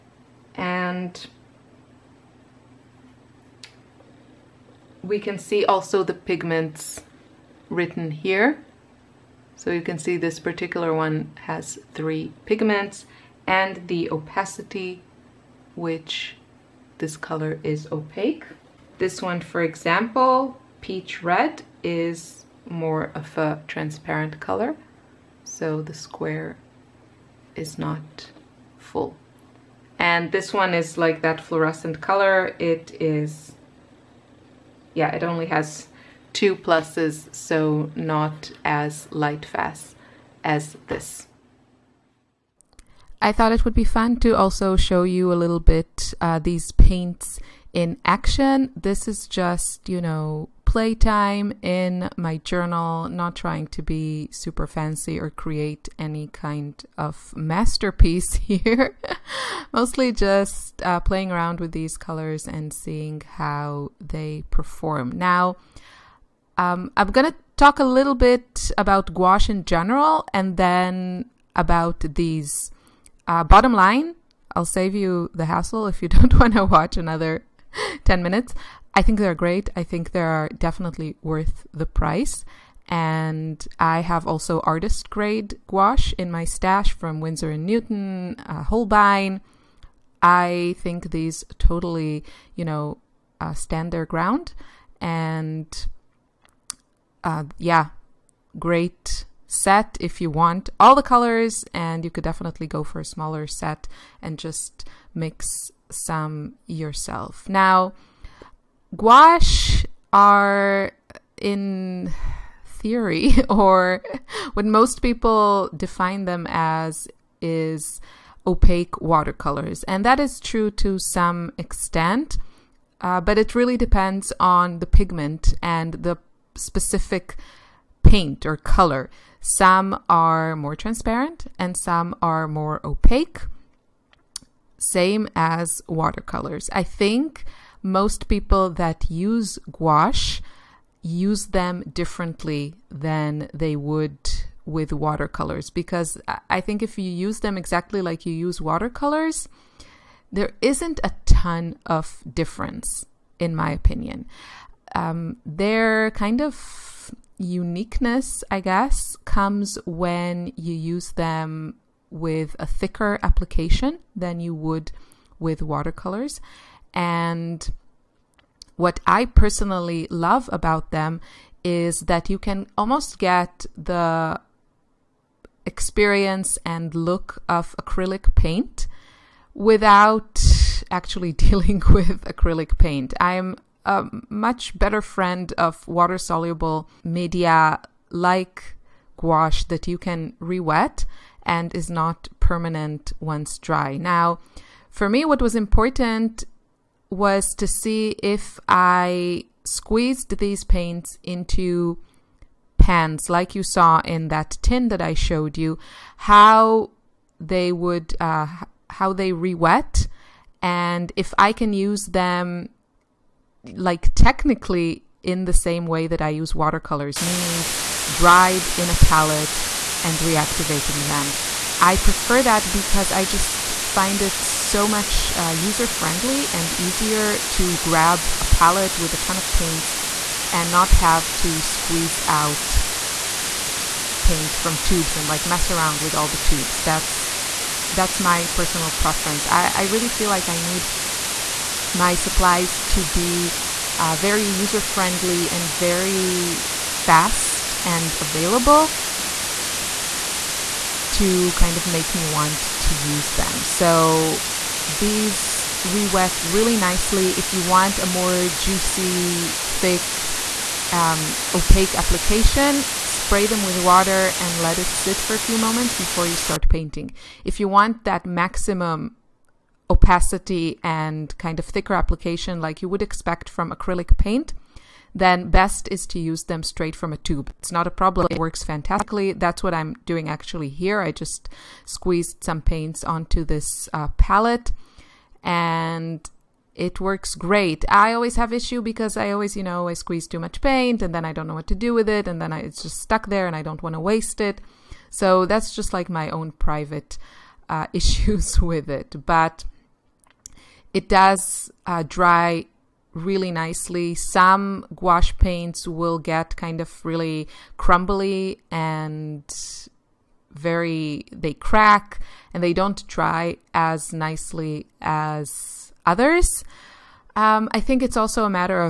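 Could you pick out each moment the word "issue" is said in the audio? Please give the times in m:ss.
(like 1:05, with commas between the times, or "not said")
4:48, 4:57.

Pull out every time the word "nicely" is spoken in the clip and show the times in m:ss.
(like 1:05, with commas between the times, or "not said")
4:16, 5:03, 5:14.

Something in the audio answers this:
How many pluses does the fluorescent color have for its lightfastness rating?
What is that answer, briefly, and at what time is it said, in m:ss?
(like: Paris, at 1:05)
2, at 0:36.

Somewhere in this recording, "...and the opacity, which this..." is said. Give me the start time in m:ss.
0:13.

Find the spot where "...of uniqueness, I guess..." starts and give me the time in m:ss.
2:36.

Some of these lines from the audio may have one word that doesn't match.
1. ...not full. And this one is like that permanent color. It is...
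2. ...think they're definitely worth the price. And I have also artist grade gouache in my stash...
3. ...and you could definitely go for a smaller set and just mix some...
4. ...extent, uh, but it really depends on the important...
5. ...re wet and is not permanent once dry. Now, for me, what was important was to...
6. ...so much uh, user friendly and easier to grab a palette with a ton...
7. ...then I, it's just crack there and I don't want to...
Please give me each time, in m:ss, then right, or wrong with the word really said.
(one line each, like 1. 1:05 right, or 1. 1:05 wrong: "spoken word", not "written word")
1. 0:27 wrong: "fluorescent", not "permanent"
2. 1:19 right
3. 1:41 right
4. 2:01 wrong: "pigment", not "important"
5. 3:10 right
6. 3:44 right
7. 4:52 wrong: "stuck", not "crack".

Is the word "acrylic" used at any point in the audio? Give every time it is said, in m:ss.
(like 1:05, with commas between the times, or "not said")
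2:57, 3:02, 4:33.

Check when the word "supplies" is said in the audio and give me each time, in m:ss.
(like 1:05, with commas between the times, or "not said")
4:02.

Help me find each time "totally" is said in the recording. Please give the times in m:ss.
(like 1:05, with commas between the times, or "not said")
1:31.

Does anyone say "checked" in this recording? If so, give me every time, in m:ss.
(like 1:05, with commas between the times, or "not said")
not said.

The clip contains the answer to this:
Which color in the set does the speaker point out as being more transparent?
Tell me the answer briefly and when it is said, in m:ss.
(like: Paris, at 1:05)
Peach red, at 0:20.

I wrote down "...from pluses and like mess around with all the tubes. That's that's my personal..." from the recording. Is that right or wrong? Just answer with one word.
wrong.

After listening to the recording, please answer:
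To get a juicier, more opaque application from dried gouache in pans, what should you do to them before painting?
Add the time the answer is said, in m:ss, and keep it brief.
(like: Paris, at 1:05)
Spray them with water, at 4:23.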